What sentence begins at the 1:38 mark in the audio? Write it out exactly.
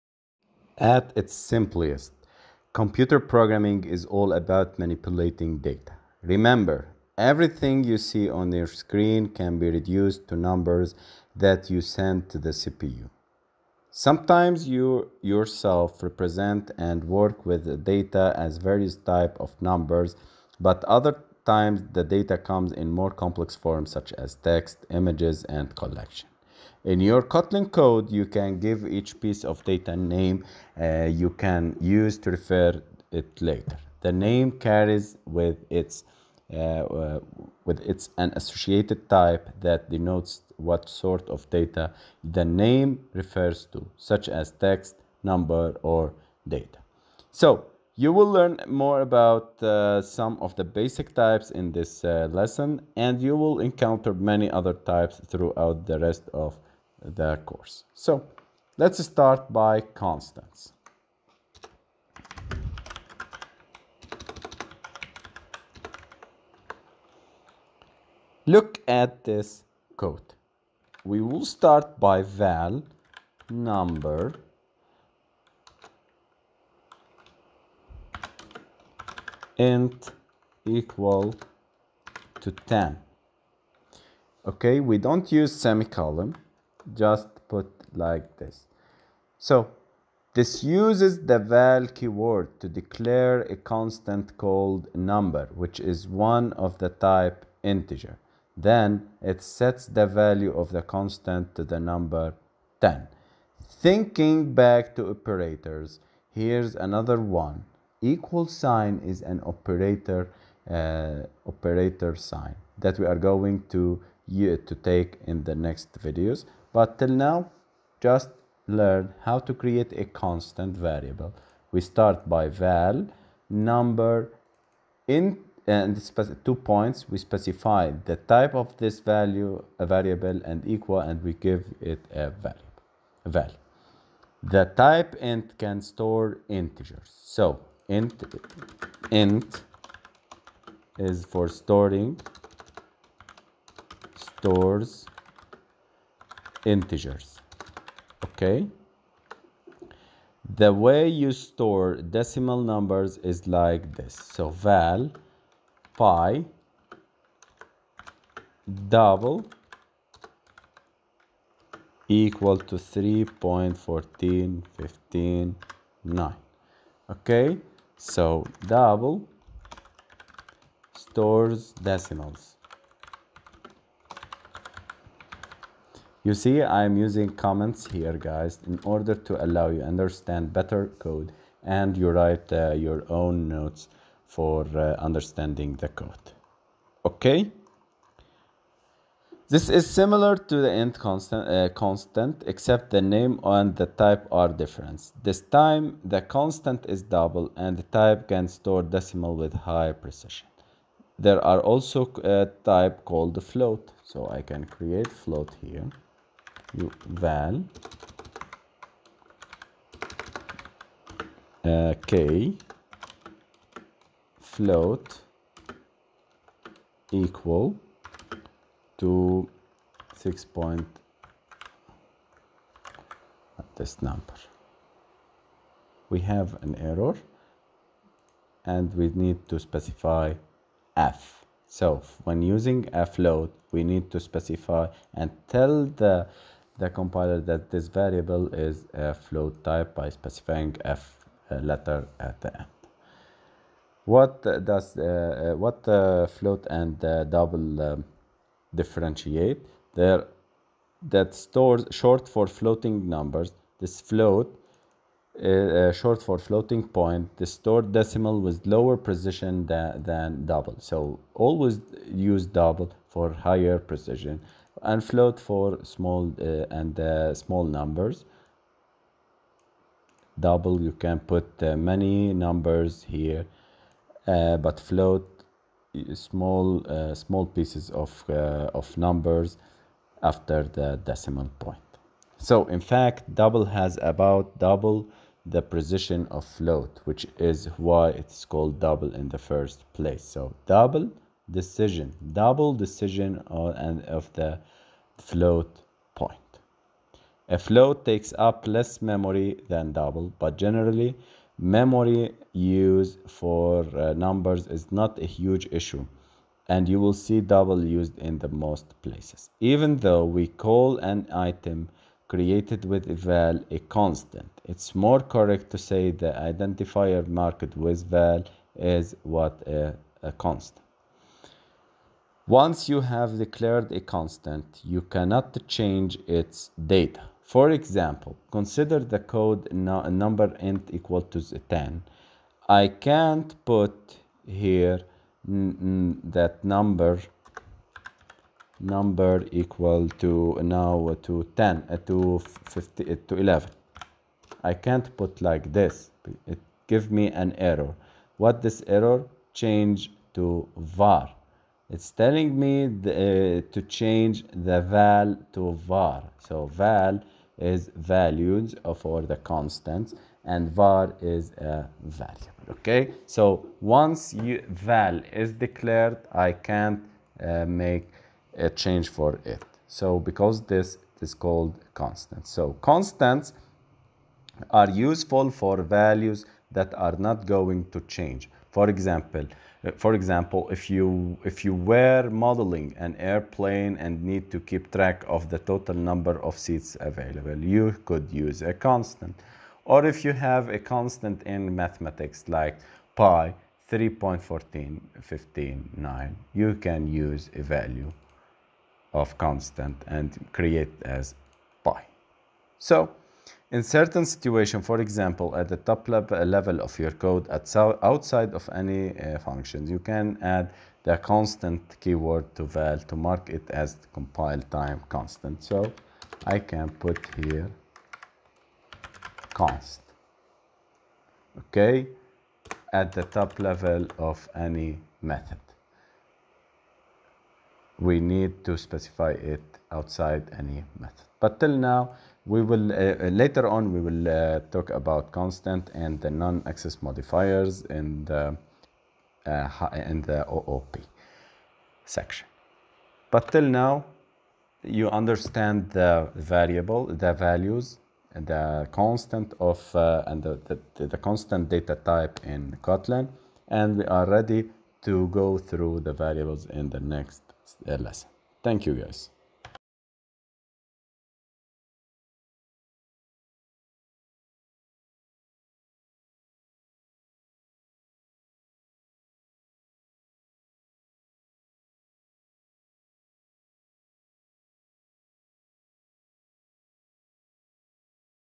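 Then it sets the value of the constant to the number 10.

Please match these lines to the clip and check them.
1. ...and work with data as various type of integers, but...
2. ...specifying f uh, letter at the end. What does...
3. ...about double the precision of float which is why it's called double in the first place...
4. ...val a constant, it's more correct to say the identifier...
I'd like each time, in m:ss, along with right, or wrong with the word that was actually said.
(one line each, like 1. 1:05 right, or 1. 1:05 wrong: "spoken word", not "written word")
1. 0:16 wrong: "numbers", not "integers"
2. 4:00 right
3. 4:44 right
4. 5:13 right.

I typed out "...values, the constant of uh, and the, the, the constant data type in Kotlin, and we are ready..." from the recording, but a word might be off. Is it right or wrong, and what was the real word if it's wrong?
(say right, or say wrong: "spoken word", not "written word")
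right.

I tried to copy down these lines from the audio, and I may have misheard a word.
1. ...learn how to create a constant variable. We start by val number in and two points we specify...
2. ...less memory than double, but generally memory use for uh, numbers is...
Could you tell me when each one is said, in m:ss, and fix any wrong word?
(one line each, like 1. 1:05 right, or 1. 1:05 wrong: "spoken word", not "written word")
1. 1:58 right
2. 4:58 right.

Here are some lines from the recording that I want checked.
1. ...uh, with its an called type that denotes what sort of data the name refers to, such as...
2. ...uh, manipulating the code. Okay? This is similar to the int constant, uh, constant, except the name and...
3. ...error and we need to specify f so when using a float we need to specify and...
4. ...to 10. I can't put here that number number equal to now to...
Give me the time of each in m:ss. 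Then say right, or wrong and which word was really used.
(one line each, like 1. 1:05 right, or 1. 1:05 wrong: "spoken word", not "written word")
1. 0:36 wrong: "associated", not "called"
2. 3:04 wrong: "understanding", not "manipulating"
3. 3:46 right
4. 5:31 right.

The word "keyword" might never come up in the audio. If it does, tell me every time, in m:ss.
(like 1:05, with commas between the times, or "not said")
1:31, 6:52.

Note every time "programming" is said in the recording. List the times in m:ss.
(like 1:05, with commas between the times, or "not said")
0:03.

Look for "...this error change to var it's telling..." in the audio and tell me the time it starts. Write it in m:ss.
5:48.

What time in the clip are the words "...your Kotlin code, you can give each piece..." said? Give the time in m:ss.
0:26.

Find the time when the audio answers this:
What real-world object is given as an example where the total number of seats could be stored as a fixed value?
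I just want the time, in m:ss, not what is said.
6:23.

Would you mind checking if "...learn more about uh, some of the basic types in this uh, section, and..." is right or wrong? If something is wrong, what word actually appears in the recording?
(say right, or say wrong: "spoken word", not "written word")
wrong: "lesson", not "section".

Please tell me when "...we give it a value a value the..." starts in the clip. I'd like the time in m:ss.
2:11.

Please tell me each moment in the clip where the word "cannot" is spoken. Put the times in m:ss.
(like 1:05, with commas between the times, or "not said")
5:25.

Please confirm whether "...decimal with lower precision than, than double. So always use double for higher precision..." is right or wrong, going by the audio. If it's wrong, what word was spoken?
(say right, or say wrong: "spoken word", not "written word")
right.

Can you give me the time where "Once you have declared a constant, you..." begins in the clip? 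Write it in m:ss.
5:22.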